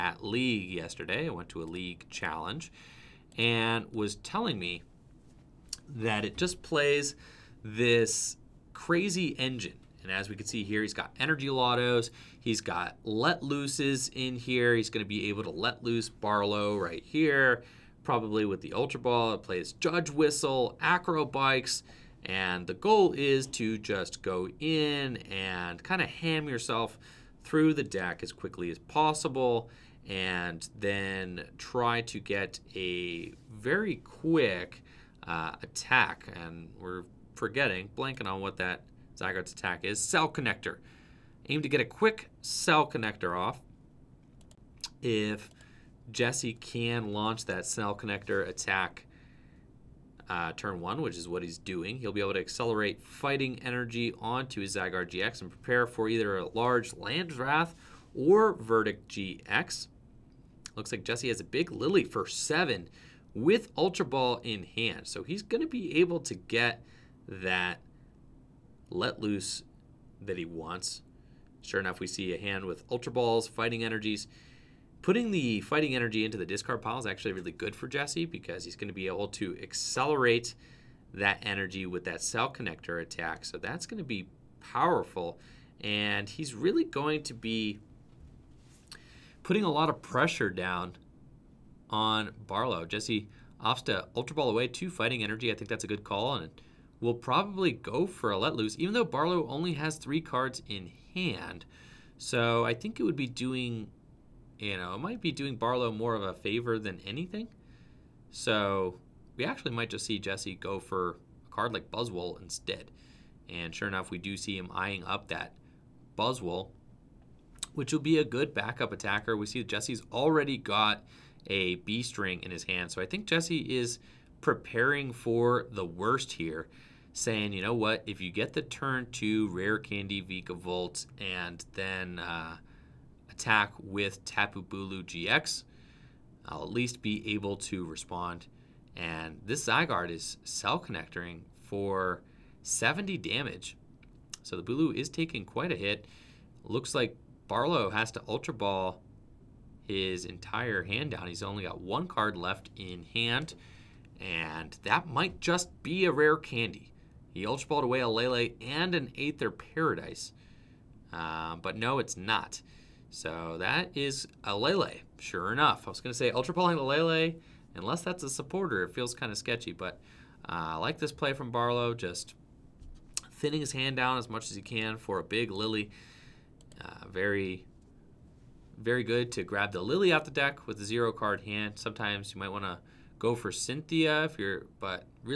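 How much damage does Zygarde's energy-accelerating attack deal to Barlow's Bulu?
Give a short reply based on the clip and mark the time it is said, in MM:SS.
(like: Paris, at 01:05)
70, at 02:22.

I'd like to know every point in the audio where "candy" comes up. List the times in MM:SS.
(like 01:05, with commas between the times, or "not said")
02:09, 02:36.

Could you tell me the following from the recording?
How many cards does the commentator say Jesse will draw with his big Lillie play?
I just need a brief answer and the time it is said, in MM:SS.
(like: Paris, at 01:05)
7, at 01:02.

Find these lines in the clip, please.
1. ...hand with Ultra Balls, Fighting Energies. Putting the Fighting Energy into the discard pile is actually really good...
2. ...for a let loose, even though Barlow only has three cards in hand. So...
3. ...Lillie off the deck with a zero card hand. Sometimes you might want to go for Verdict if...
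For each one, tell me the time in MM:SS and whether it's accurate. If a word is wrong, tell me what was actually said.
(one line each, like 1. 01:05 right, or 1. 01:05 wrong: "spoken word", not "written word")
1. 01:12 right
2. 01:38 right
3. 02:59 wrong: "Cynthia", not "Verdict".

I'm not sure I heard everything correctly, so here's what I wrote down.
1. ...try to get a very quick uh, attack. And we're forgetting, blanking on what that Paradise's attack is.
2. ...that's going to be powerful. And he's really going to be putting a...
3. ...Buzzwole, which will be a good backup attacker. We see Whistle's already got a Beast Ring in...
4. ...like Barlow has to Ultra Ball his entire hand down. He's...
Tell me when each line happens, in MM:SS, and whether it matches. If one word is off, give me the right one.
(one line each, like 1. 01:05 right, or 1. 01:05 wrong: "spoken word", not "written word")
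1. 00:31 wrong: "Zygarde", not "Paradise"
2. 01:23 right
3. 01:56 wrong: "Jesse", not "Whistle"
4. 02:26 right.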